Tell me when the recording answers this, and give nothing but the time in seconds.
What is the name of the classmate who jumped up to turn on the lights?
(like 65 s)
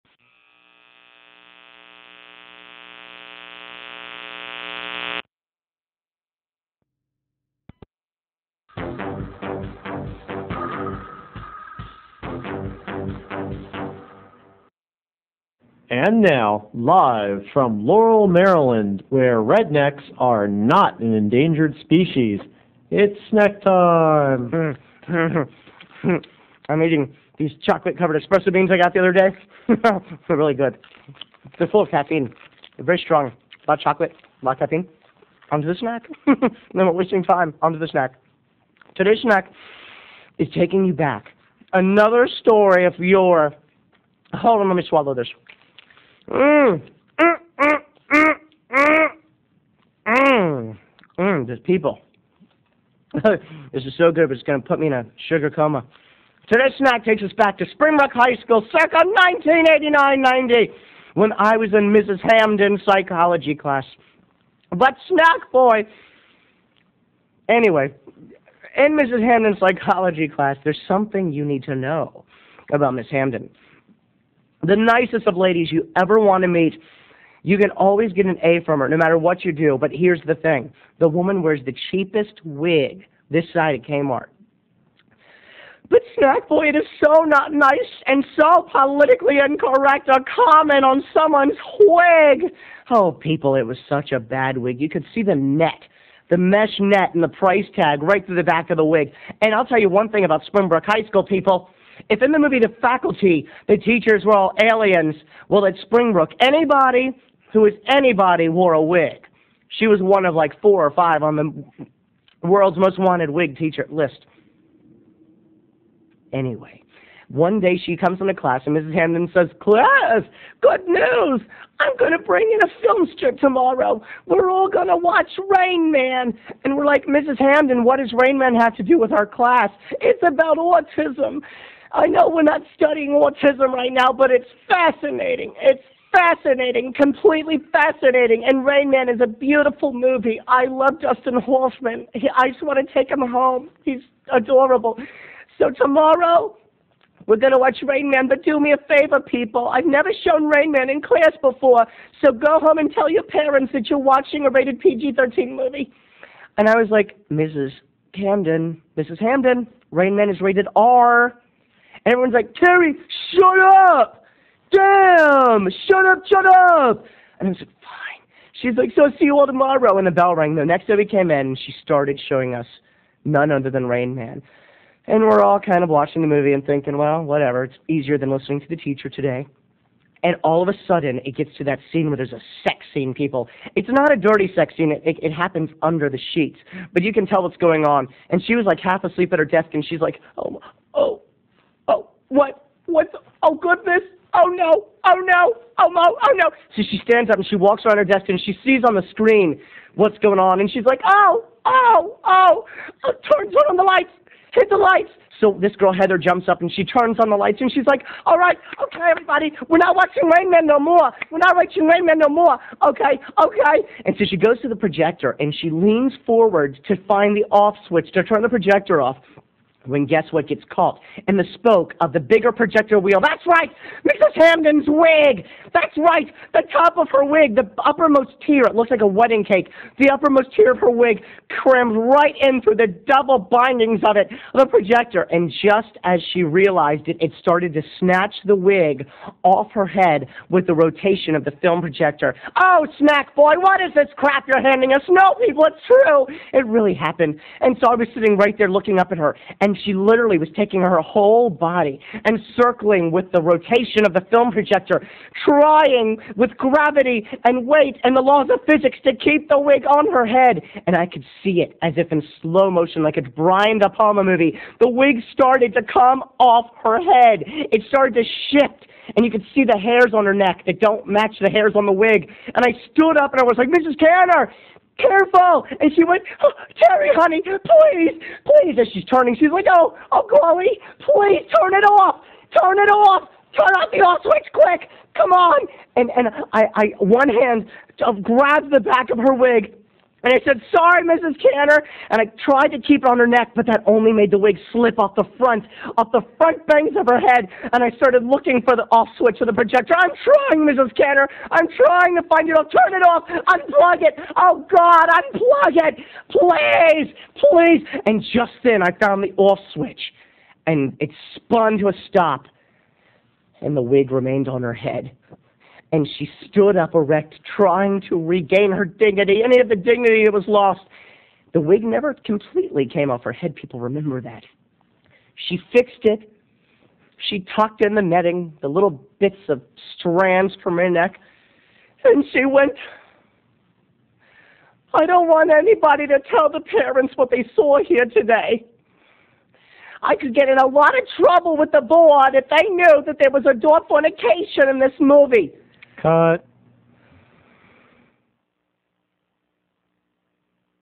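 205 s.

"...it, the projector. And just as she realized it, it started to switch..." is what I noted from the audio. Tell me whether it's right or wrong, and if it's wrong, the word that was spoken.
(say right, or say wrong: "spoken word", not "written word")
wrong: "snatch", not "switch".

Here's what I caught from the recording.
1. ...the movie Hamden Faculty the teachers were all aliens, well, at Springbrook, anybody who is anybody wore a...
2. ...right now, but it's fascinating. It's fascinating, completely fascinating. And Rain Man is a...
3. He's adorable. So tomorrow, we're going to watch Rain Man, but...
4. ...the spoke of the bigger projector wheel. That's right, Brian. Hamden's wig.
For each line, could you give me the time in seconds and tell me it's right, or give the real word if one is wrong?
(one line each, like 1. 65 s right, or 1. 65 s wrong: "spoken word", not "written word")
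1. 102 s wrong: "The", not "Hamden"
2. 133 s right
3. 143 s right
4. 221 s wrong: "Mrs", not "Brian".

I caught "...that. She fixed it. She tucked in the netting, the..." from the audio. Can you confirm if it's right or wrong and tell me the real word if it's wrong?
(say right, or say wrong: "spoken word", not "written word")
right.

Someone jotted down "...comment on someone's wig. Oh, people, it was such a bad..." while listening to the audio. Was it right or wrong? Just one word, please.
right.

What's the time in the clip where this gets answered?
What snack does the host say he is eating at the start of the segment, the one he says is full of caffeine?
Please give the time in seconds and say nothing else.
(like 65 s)
27 s.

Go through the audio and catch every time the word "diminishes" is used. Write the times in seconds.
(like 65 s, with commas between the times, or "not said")
not said.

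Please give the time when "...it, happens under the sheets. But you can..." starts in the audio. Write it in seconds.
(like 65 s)
185 s.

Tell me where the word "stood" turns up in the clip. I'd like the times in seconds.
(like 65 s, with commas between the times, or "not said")
272 s, 316 s.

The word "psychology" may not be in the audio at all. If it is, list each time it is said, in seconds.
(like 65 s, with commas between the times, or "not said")
62 s, 69 s.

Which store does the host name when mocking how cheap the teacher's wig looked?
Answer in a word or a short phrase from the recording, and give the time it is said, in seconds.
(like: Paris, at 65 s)
Kmart, at 83 s.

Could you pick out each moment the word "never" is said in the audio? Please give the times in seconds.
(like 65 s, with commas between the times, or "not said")
149 s, 321 s.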